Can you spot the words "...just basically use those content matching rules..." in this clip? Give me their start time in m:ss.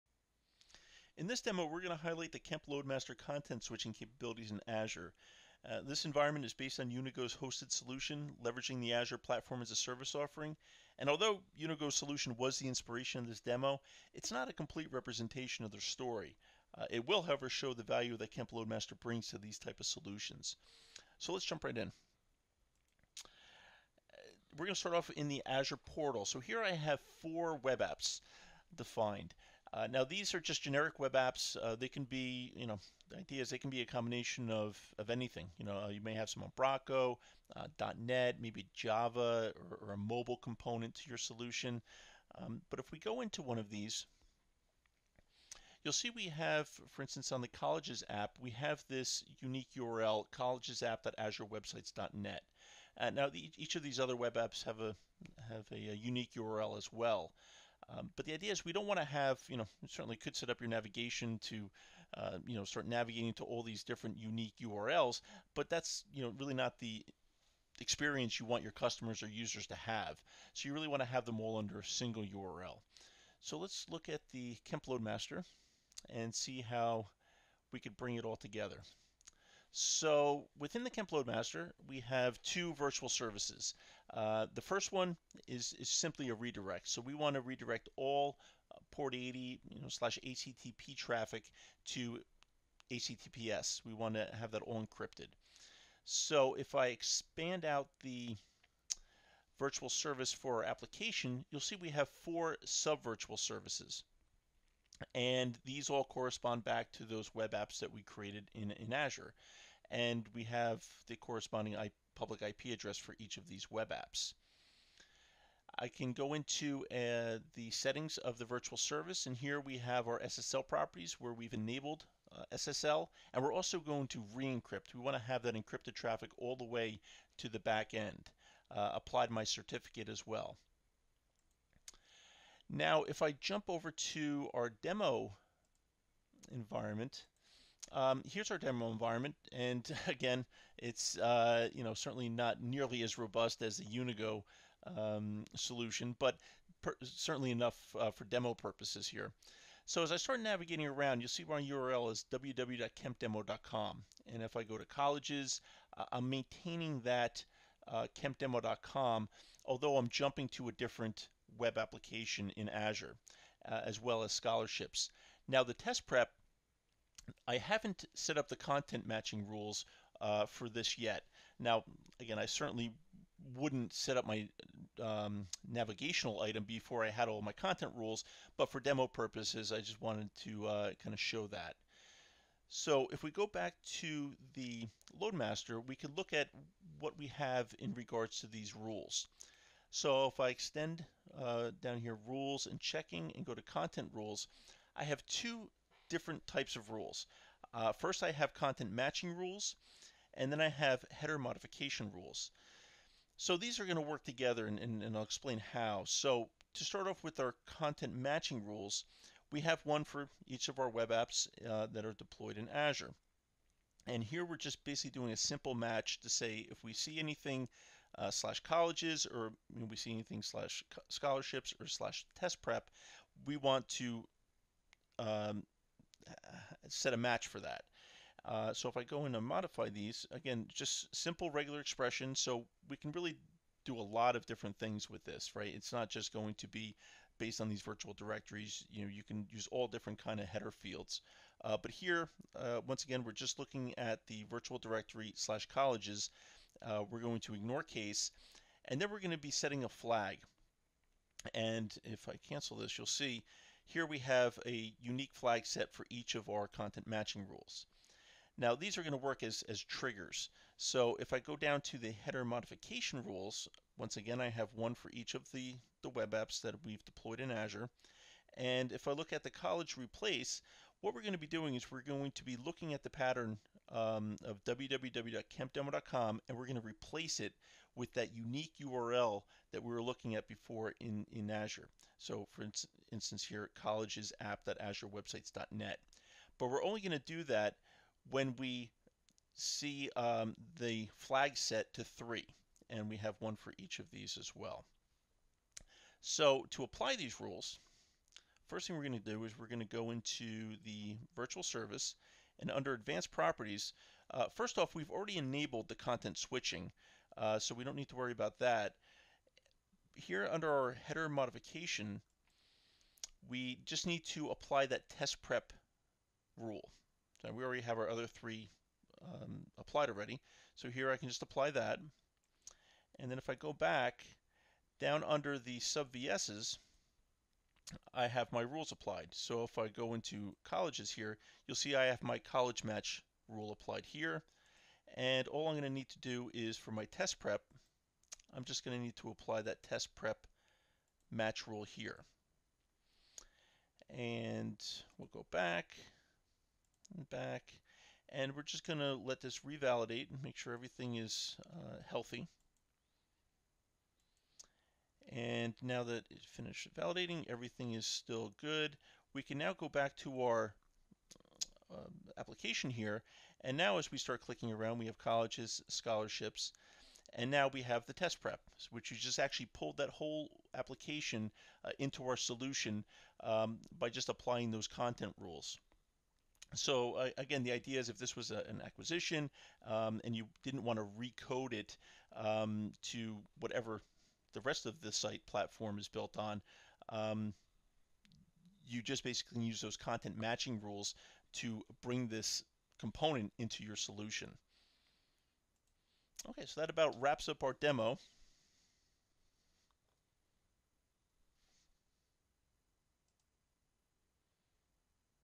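6:29.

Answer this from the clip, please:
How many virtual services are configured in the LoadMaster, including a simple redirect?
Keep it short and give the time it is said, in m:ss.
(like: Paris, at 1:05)
2, at 1:22.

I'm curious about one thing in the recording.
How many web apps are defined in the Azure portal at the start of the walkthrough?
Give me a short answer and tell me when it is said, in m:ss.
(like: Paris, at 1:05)
4, at 0:27.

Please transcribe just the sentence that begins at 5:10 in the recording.
Here under our header modification, we just need to apply that test prep rule.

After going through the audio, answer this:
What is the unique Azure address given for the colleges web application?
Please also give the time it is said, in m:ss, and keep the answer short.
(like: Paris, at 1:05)
collegesapp.azurewebsites.net, at 0:50.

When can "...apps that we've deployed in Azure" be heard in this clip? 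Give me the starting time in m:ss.
4:26.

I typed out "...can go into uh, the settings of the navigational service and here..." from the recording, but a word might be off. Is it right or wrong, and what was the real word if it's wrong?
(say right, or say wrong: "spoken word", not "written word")
wrong: "virtual", not "navigational".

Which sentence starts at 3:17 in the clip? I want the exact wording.
Uh, first, I have content matching rules, and then I have header modification rules.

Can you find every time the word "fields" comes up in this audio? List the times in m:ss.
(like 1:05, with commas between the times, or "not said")
4:00.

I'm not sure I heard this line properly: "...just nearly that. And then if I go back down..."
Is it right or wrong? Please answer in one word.
wrong.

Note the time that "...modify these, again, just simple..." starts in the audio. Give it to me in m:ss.
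3:49.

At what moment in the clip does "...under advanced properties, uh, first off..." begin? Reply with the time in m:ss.
5:02.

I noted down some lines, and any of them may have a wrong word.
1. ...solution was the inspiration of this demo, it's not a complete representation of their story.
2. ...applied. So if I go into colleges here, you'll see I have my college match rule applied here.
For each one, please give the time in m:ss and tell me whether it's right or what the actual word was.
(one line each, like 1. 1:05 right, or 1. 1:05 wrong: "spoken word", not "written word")
1. 0:11 right
2. 5:28 right.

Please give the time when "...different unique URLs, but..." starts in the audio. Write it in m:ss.
1:03.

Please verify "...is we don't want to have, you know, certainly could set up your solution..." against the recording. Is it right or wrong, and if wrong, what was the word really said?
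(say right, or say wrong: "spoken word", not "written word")
wrong: "navigation", not "solution".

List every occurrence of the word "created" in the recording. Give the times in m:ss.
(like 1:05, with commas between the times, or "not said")
1:48.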